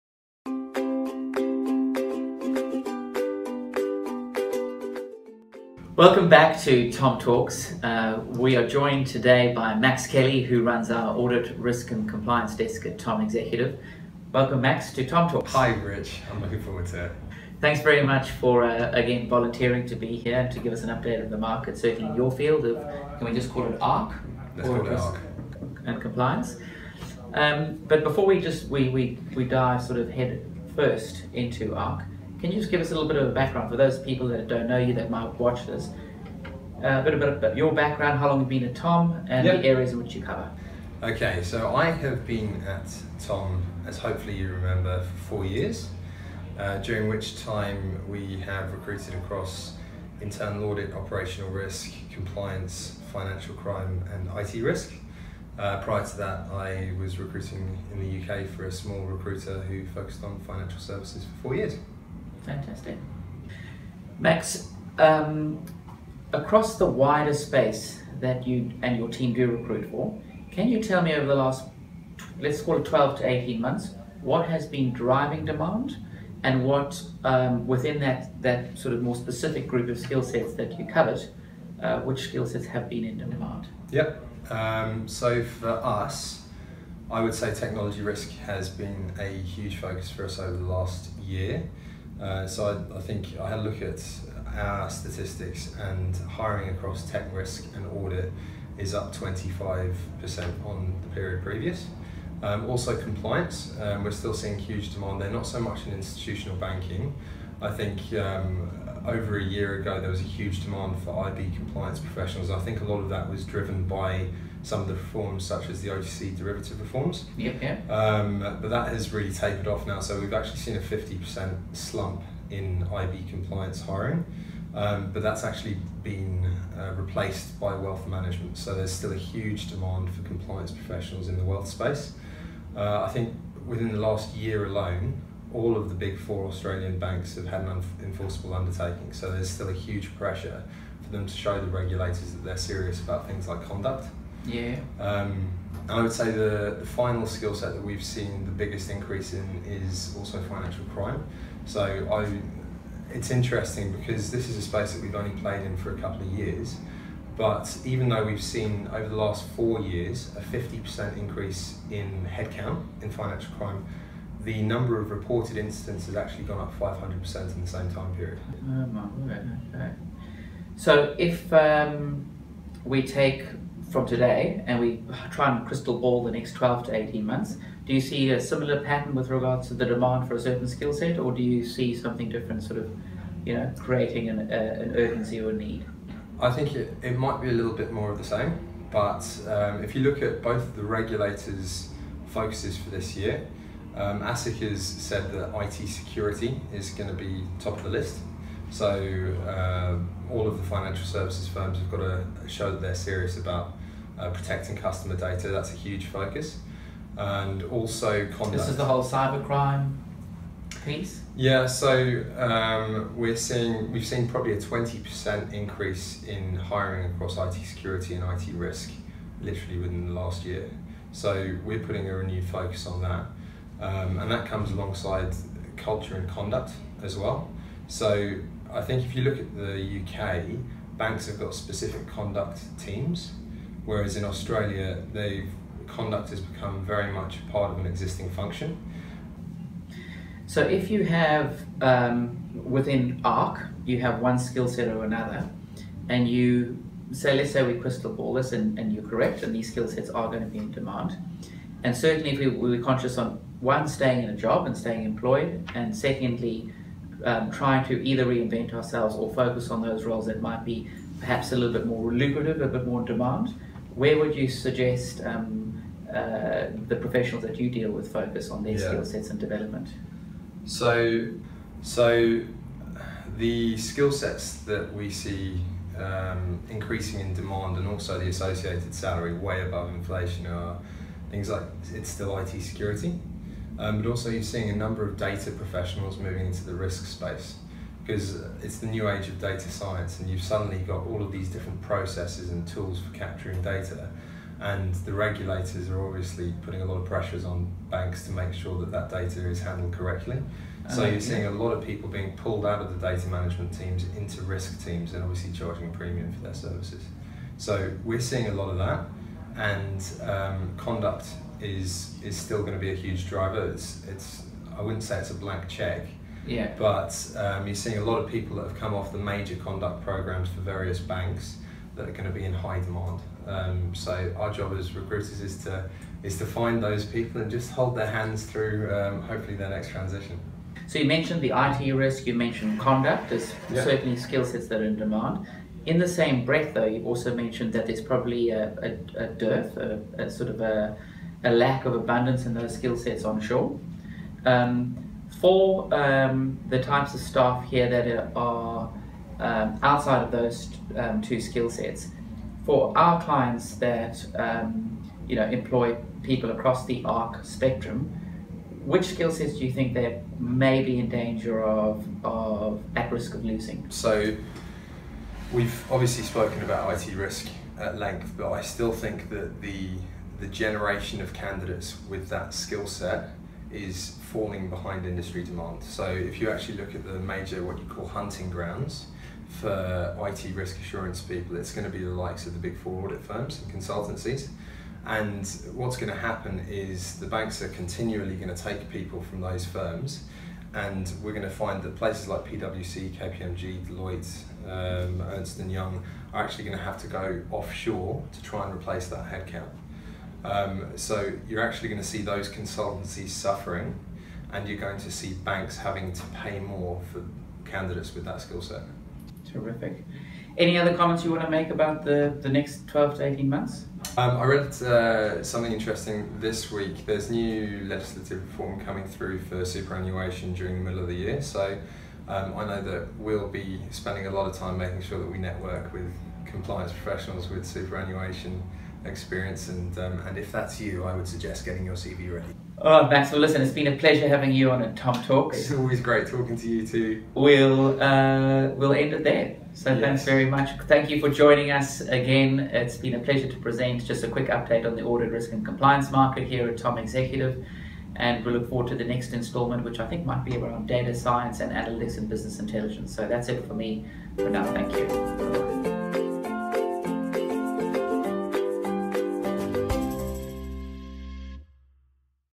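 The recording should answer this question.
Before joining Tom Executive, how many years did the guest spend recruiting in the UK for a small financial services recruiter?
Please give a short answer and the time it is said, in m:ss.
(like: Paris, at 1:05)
4 years, at 1:01.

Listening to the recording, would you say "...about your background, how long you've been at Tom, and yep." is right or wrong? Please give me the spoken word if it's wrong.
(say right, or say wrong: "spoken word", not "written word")
right.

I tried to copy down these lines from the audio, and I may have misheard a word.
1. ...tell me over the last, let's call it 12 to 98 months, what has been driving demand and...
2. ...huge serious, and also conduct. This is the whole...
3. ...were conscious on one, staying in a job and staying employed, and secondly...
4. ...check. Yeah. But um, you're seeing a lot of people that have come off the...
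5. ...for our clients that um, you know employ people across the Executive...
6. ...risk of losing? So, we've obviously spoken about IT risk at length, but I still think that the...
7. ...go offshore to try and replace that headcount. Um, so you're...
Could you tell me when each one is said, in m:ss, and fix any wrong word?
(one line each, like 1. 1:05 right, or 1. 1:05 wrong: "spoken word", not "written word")
1. 1:10 wrong: "18", not "98"
2. 3:25 wrong: "focus", not "serious"
3. 4:12 right
4. 5:15 right
5. 5:52 wrong: "ARC", not "Executive"
6. 6:03 right
7. 6:37 right.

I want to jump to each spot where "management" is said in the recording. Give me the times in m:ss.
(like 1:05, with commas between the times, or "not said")
2:08, 5:03.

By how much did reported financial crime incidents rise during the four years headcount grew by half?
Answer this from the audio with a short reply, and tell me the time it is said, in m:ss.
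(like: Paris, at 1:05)
500%, at 2:46.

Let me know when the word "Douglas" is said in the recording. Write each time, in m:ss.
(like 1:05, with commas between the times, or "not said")
not said.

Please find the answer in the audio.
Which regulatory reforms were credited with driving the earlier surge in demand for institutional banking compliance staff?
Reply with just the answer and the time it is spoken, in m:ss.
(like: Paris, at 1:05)
OTC derivative reforms, at 1:55.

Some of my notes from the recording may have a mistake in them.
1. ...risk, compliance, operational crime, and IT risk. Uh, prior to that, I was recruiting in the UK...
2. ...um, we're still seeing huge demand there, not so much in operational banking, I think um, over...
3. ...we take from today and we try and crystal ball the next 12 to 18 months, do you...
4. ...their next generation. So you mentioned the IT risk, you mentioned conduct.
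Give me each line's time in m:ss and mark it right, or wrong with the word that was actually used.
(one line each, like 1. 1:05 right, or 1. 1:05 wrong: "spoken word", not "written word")
1. 0:51 wrong: "financial", not "operational"
2. 1:43 wrong: "institutional", not "operational"
3. 2:52 right
4. 5:29 wrong: "transition", not "generation".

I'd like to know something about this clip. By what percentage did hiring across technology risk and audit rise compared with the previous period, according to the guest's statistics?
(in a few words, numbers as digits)
25%.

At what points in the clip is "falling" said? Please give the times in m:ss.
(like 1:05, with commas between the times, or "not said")
6:14.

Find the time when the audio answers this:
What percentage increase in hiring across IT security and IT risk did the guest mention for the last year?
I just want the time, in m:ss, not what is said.
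3:34.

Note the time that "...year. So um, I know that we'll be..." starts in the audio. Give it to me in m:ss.
7:01.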